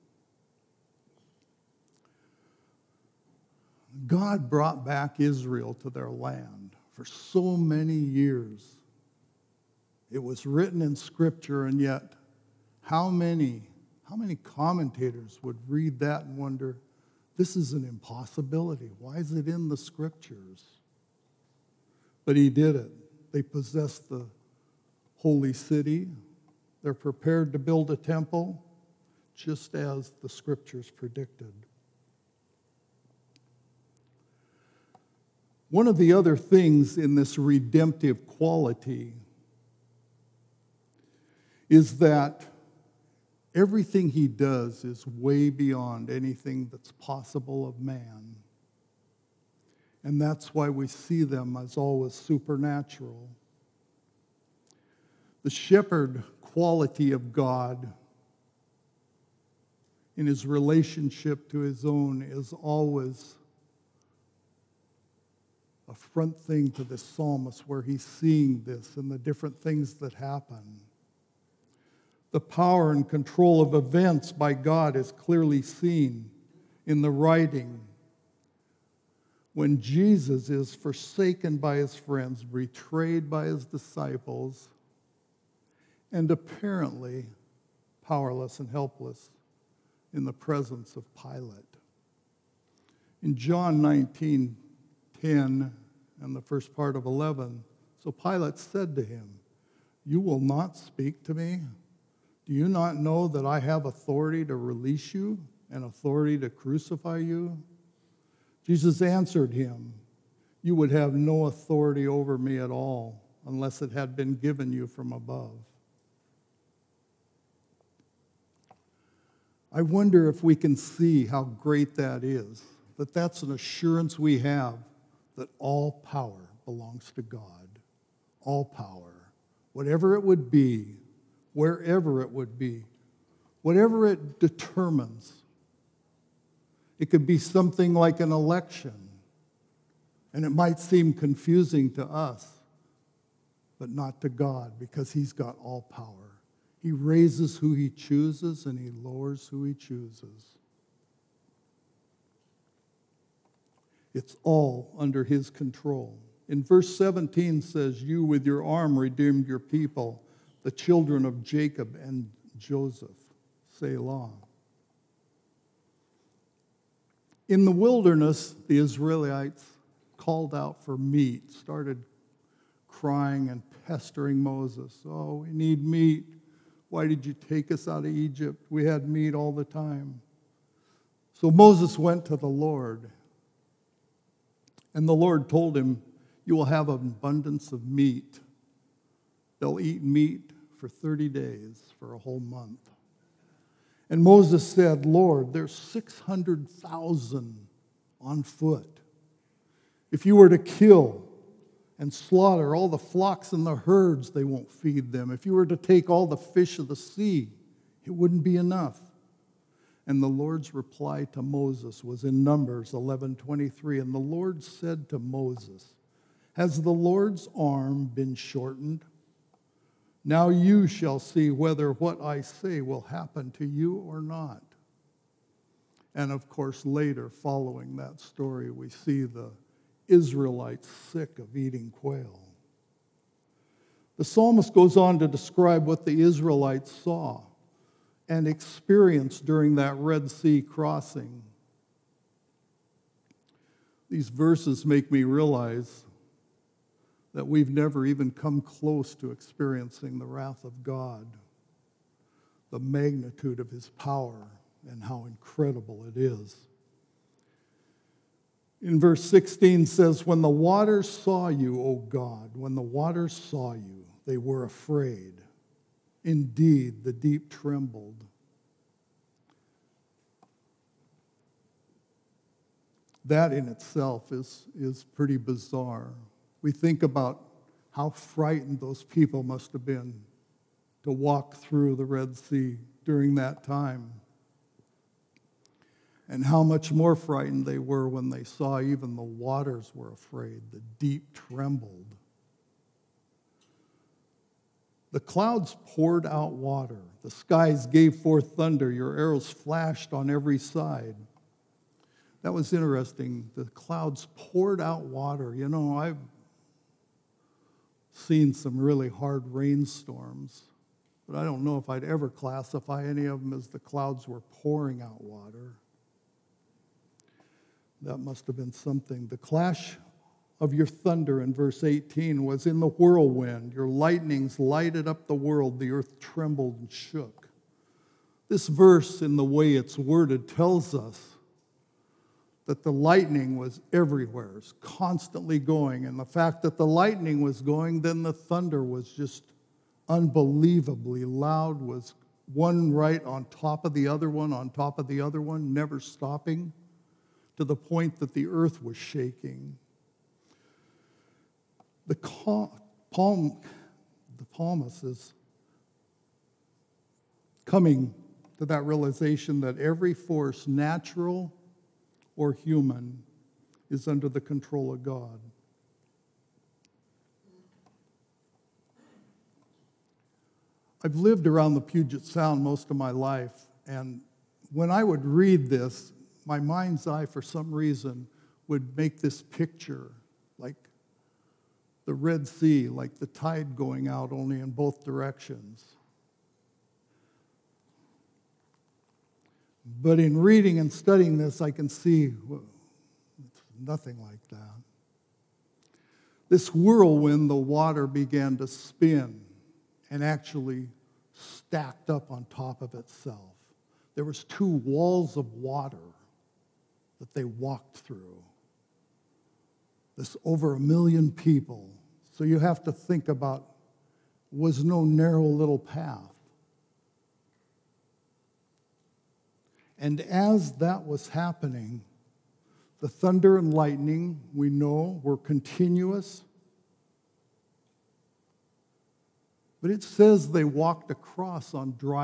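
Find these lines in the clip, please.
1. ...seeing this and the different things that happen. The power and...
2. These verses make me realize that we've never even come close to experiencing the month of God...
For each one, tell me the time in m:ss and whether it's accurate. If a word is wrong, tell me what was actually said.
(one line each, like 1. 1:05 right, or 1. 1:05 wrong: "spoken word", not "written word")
1. 1:08 right
2. 4:04 wrong: "wrath", not "month".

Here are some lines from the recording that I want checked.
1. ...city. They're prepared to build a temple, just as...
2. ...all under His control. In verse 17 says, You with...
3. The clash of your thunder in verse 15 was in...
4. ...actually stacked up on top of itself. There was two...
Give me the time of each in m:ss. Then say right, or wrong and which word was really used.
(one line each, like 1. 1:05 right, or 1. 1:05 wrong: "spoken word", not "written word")
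1. 0:25 right
2. 2:34 right
3. 5:19 wrong: "18", not "15"
4. 6:40 right.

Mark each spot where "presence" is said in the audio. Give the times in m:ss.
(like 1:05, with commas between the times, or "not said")
1:30.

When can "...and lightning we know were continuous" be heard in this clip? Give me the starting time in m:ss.
7:03.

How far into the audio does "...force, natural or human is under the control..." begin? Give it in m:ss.
6:00.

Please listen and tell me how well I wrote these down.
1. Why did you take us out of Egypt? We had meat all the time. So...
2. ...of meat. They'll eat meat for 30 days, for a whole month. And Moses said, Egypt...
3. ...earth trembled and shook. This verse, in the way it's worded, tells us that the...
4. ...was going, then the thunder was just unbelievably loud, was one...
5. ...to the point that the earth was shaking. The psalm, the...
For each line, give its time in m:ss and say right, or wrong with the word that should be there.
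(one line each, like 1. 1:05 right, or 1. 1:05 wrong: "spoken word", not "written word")
1. 2:56 right
2. 3:07 wrong: "Lord", not "Egypt"
3. 5:25 right
4. 5:37 right
5. 5:47 right.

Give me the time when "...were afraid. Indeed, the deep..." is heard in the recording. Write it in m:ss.
4:24.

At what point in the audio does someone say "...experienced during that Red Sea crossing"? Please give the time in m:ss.
3:58.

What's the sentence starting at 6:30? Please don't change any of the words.
But in reading and studying this, I can see it's nothing like that.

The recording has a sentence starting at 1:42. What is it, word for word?
Do you not know that I have authority to release you and authority to crucify you?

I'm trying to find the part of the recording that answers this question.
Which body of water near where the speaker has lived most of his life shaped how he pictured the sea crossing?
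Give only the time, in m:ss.
6:11.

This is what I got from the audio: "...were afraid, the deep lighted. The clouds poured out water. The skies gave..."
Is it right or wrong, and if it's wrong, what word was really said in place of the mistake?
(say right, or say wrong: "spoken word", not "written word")
wrong: "trembled", not "lighted".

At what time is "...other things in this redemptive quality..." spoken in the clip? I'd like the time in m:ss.
0:36.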